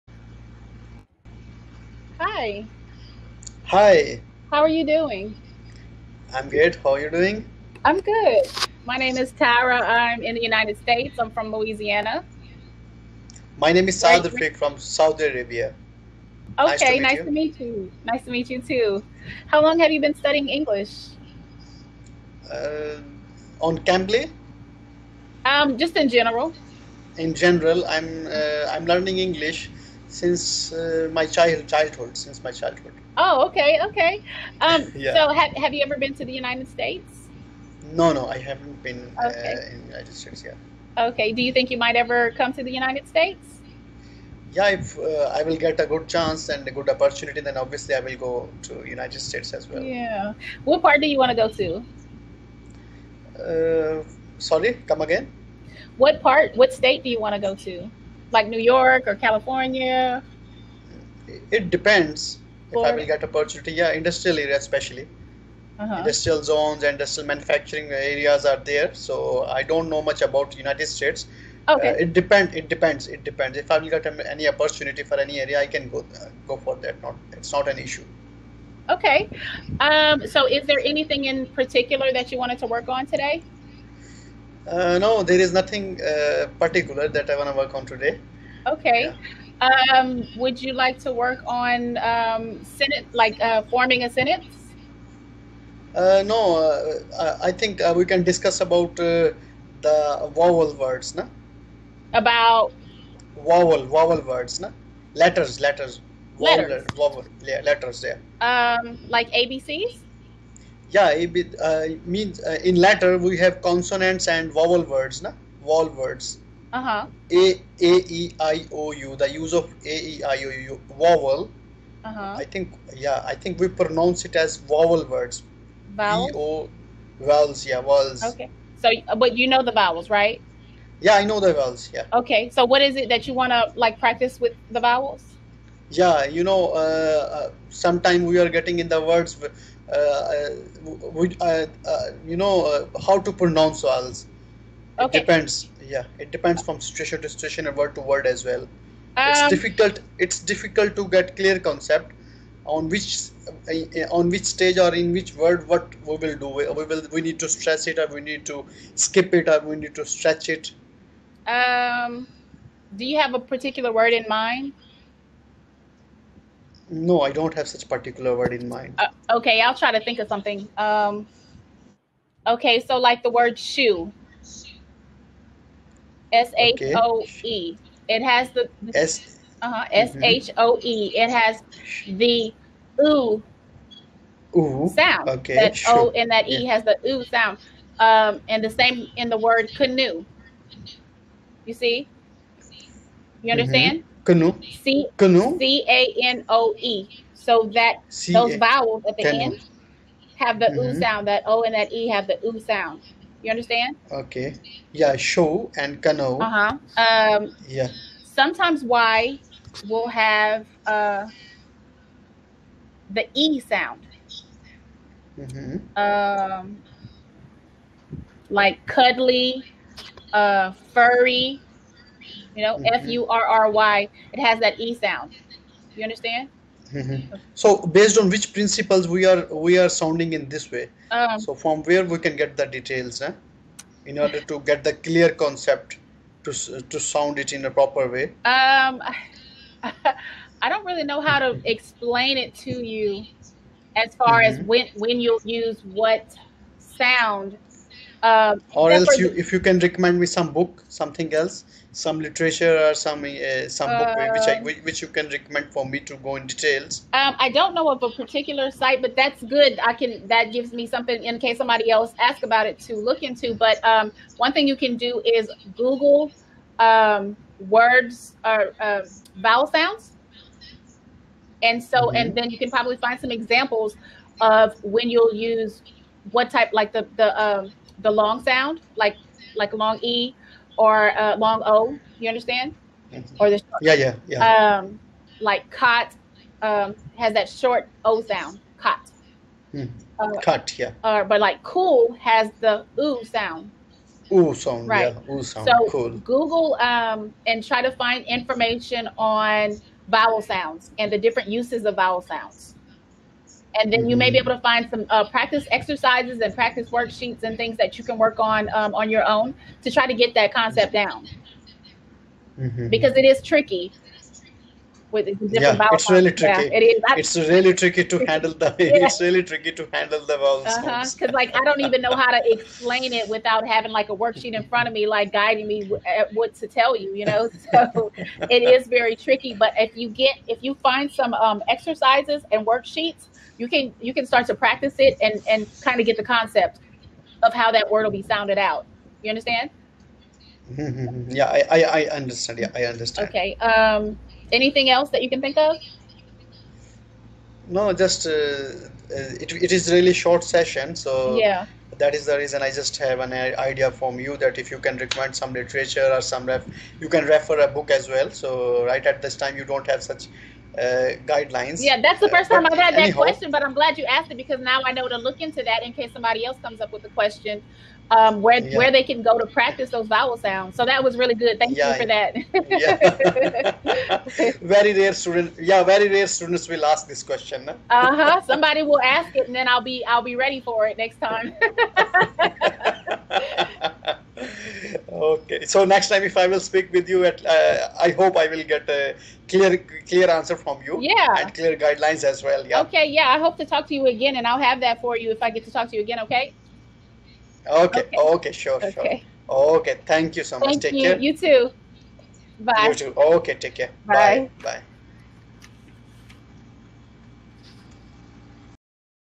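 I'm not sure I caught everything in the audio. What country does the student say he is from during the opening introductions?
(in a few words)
Saudi Arabia.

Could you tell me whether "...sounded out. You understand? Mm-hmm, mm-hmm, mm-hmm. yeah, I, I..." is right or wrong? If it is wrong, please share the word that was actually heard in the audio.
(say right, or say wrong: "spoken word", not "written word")
right.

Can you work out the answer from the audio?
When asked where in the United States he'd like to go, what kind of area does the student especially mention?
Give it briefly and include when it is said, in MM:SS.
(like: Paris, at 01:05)
Industrial area, at 01:03.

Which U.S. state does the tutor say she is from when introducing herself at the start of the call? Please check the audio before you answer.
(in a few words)
Louisiana.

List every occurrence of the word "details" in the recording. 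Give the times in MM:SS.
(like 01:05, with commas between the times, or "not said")
03:52, 04:16.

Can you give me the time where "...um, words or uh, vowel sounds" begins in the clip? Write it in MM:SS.
04:26.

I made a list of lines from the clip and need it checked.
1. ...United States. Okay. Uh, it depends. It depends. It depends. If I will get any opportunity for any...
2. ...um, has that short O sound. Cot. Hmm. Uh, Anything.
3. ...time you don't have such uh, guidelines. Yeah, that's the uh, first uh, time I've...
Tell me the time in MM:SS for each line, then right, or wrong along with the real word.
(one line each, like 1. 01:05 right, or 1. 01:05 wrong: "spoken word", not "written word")
1. 01:10 right
2. 04:46 wrong: "Cut", not "Anything"
3. 05:59 right.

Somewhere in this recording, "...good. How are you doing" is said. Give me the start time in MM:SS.
00:06.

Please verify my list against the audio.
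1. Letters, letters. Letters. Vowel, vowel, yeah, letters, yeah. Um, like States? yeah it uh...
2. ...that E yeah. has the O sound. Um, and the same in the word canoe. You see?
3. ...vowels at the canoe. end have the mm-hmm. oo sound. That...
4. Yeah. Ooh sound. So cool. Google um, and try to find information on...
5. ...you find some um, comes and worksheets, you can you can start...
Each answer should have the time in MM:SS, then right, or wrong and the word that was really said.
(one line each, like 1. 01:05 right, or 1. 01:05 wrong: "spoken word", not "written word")
1. 01:45 wrong: "ABCs", not "States"
2. 03:06 right
3. 03:18 right
4. 04:55 right
5. 05:30 wrong: "exercises", not "comes".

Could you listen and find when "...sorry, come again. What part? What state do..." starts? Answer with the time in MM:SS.
00:54.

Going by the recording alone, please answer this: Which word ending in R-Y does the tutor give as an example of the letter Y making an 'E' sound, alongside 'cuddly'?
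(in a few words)
Furry.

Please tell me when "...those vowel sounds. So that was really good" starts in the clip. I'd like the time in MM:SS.
06:09.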